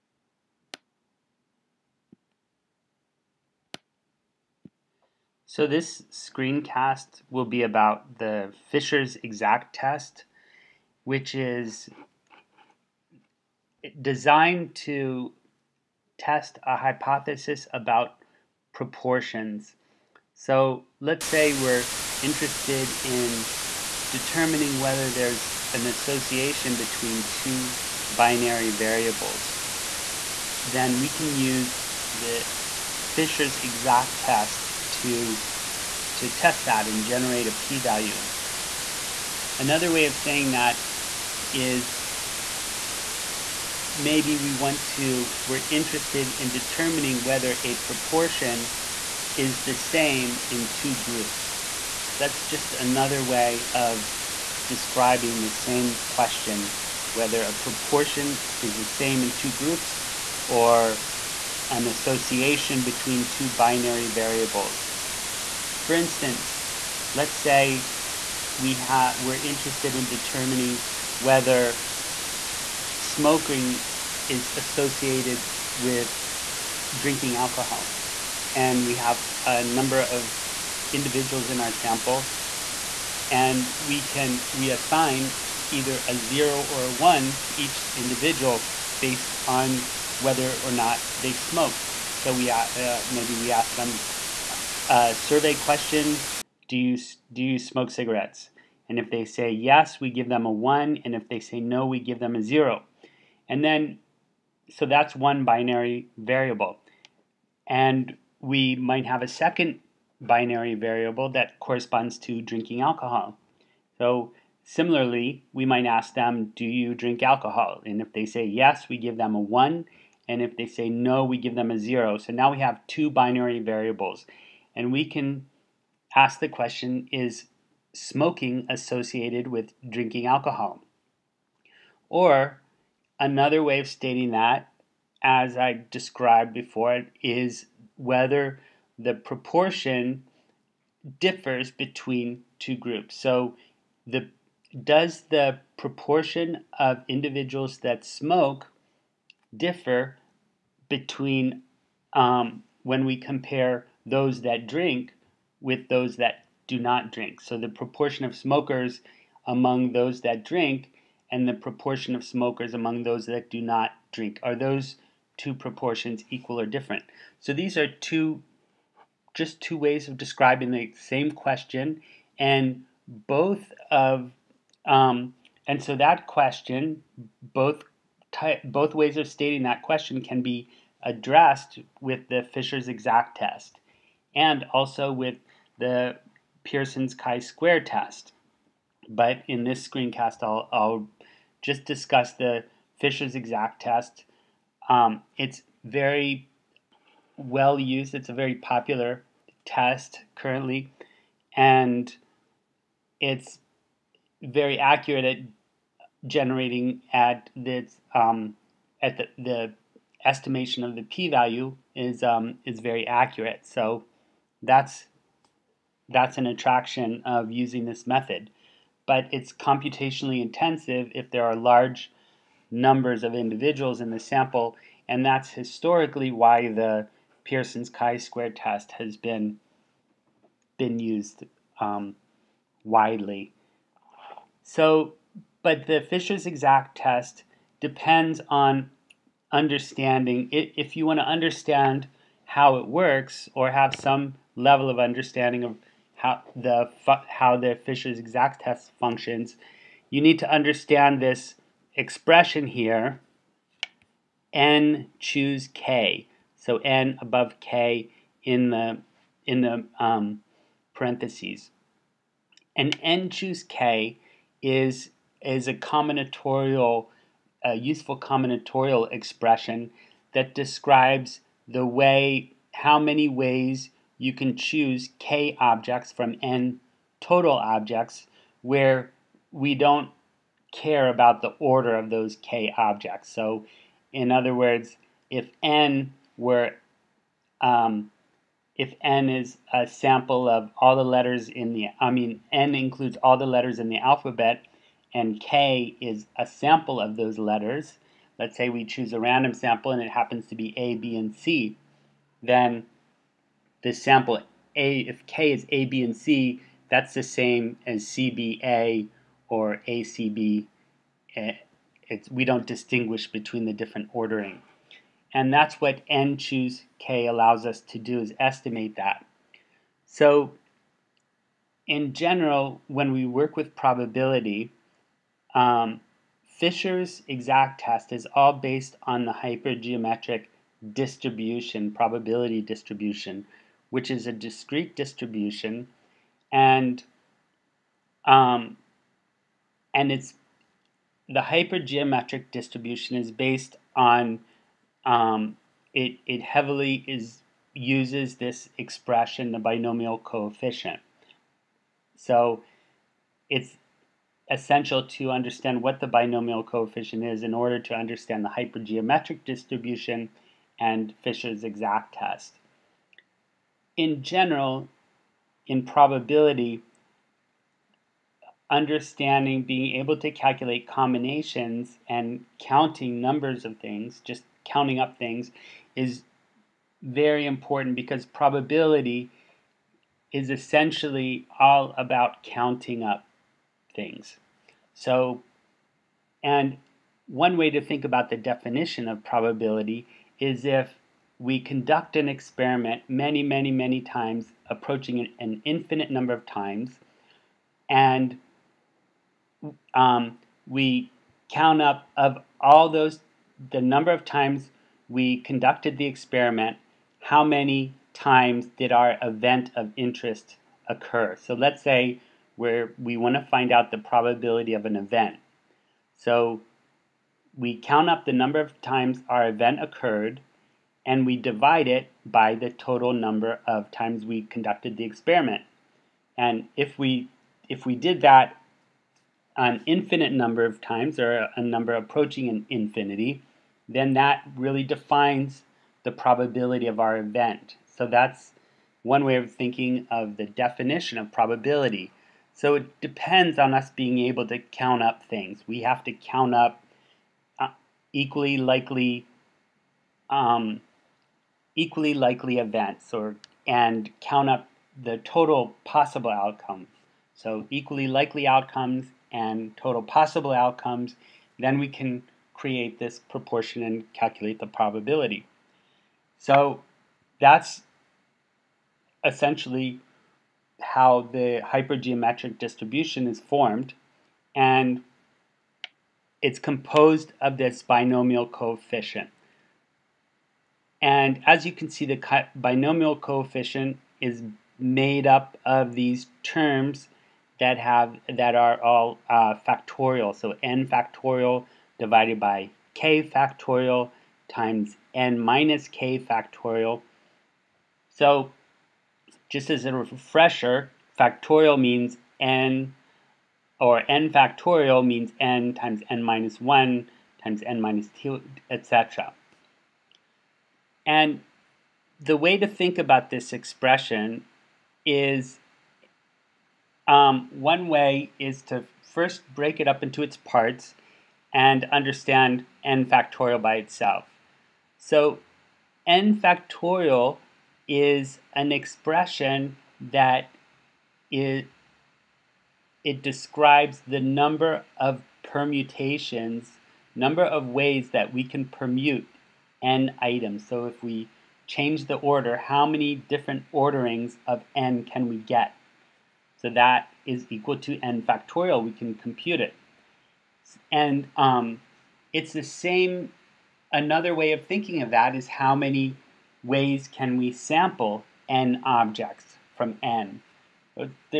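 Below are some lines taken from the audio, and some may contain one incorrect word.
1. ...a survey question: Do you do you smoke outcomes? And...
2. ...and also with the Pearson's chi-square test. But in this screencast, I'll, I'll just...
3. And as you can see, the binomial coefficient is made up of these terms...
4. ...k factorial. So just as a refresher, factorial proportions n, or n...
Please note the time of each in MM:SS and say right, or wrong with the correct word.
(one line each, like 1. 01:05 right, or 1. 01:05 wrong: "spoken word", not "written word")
1. 01:34 wrong: "cigarettes", not "outcomes"
2. 03:04 right
3. 08:01 right
4. 08:15 wrong: "means", not "proportions".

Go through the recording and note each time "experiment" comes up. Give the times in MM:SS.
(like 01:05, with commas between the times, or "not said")
06:32, 06:46, 07:05.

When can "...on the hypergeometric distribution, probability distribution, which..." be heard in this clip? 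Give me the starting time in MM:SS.
05:29.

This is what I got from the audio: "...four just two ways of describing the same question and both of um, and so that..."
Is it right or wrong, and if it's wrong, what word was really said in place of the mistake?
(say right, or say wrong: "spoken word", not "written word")
wrong: "two", not "four".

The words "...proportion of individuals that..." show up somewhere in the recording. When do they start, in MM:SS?
02:25.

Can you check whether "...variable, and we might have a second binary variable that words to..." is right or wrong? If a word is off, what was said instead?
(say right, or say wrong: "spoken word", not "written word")
wrong: "corresponds", not "words".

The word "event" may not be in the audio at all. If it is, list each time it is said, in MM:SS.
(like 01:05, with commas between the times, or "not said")
06:49, 06:54, 06:59, 07:17, 07:32.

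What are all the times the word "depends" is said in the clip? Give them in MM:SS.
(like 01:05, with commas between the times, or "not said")
03:57, 07:22.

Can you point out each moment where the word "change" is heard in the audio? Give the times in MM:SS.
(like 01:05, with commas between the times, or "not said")
09:01.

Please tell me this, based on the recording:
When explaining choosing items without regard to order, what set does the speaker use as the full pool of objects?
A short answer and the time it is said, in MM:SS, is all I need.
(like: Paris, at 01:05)
Letters in the alphabet, at 04:53.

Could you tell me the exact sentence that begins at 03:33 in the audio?
So that's that's an attraction of using this method.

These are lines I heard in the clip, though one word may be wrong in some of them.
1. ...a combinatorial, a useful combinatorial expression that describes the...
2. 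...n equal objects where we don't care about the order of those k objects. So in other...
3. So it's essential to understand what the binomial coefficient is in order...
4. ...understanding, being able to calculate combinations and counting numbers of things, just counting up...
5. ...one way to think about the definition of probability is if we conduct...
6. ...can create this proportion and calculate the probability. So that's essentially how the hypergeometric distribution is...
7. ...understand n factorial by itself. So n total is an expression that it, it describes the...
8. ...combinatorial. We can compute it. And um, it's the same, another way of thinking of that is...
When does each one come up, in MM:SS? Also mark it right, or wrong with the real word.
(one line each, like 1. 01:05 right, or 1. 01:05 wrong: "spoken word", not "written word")
1. 04:25 right
2. 04:36 wrong: "total", not "equal"
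3. 05:52 right
4. 06:08 right
5. 06:27 right
6. 07:41 right
7. 08:41 wrong: "factorial", not "total"
8. 09:08 wrong: "factorial", not "combinatorial".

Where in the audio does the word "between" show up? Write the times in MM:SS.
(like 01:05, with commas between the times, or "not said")
00:26, 01:02, 02:21, 02:30, 05:13.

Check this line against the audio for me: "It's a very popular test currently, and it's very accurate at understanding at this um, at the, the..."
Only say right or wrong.
wrong.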